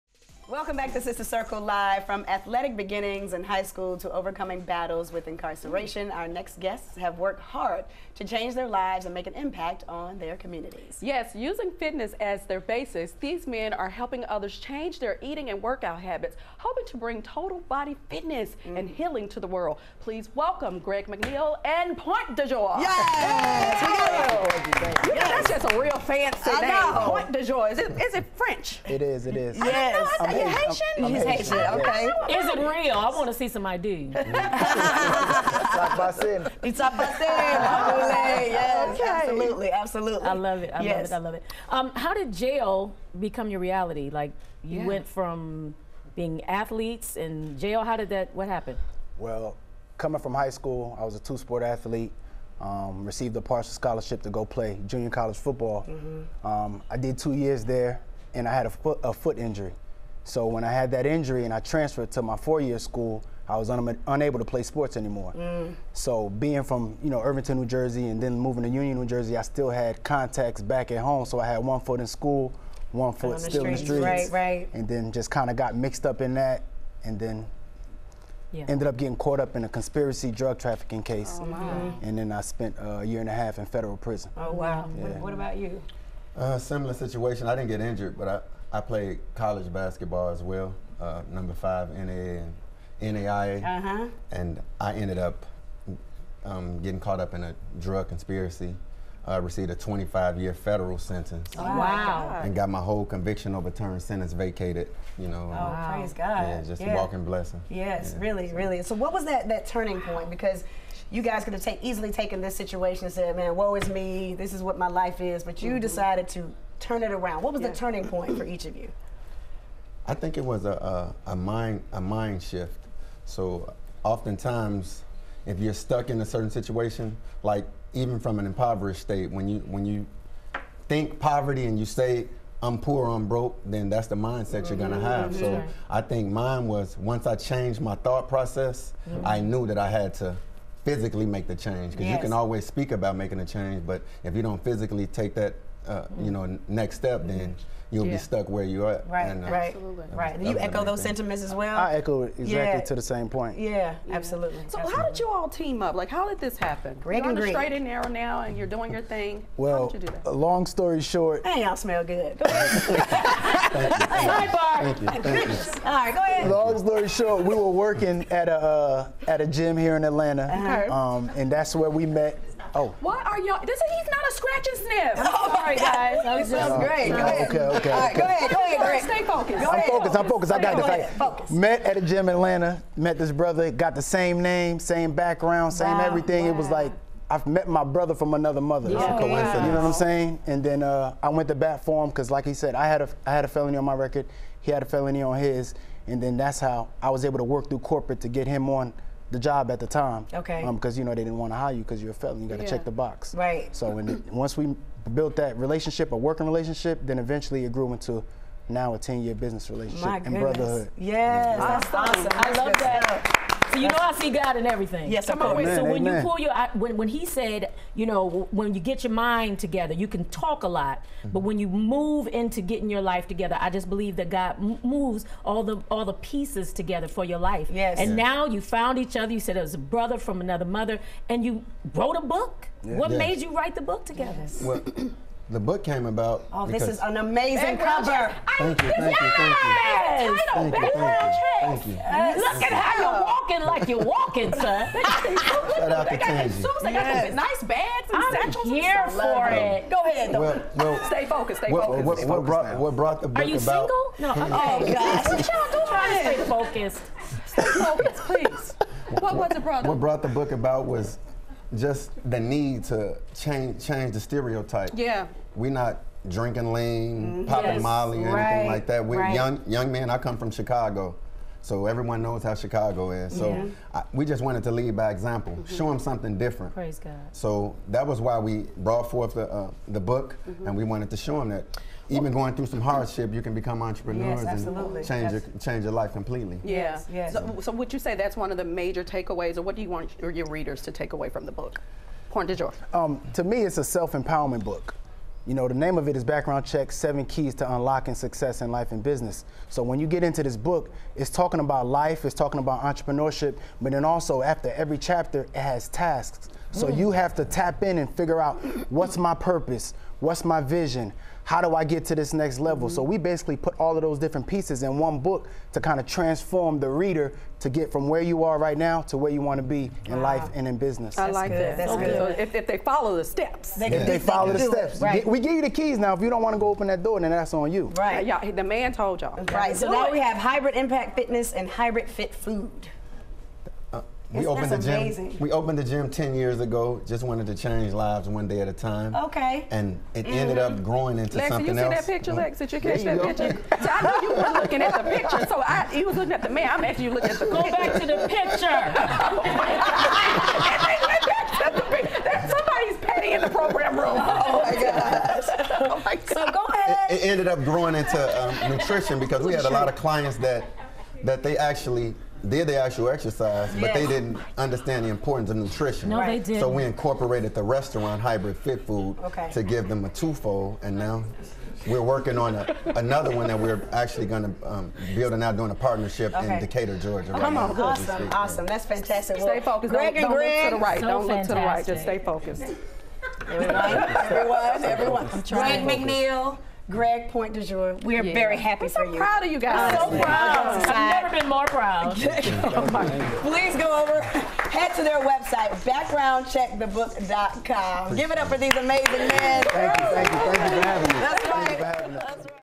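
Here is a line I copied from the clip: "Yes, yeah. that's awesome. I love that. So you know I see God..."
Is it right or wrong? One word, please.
right.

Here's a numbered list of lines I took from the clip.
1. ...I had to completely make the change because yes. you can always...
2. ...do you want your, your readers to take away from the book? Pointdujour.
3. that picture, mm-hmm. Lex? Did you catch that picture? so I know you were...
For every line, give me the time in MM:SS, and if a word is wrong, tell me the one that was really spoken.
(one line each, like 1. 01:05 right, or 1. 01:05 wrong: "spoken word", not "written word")
1. 02:19 wrong: "physically", not "completely"
2. 04:49 right
3. 05:42 right.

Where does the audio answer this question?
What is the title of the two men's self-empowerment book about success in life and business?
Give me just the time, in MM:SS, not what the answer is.
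04:56.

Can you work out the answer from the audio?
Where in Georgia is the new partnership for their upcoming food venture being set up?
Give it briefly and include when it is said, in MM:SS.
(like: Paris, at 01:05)
Decatur, at 06:16.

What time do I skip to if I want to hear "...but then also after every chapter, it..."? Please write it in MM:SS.
05:03.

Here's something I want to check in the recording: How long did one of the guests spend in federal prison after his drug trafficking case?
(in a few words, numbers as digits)
a year and a half.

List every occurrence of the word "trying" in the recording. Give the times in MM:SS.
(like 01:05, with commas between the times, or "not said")
04:15, 06:25.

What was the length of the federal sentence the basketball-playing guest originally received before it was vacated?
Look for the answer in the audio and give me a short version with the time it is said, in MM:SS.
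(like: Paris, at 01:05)
25 years, at 01:39.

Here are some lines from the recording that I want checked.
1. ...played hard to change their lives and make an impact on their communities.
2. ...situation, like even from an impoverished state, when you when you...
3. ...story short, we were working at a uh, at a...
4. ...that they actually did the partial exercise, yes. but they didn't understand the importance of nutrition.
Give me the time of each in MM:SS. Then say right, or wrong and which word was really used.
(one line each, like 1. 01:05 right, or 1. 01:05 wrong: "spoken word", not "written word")
1. 00:07 wrong: "worked", not "played"
2. 02:06 right
3. 02:46 right
4. 06:01 wrong: "actual", not "partial".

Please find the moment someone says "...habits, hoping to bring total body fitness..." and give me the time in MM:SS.
00:16.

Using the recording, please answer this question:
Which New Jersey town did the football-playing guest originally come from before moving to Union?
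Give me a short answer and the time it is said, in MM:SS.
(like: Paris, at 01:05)
Irvington, at 01:07.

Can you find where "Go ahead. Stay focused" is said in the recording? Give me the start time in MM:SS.
02:58.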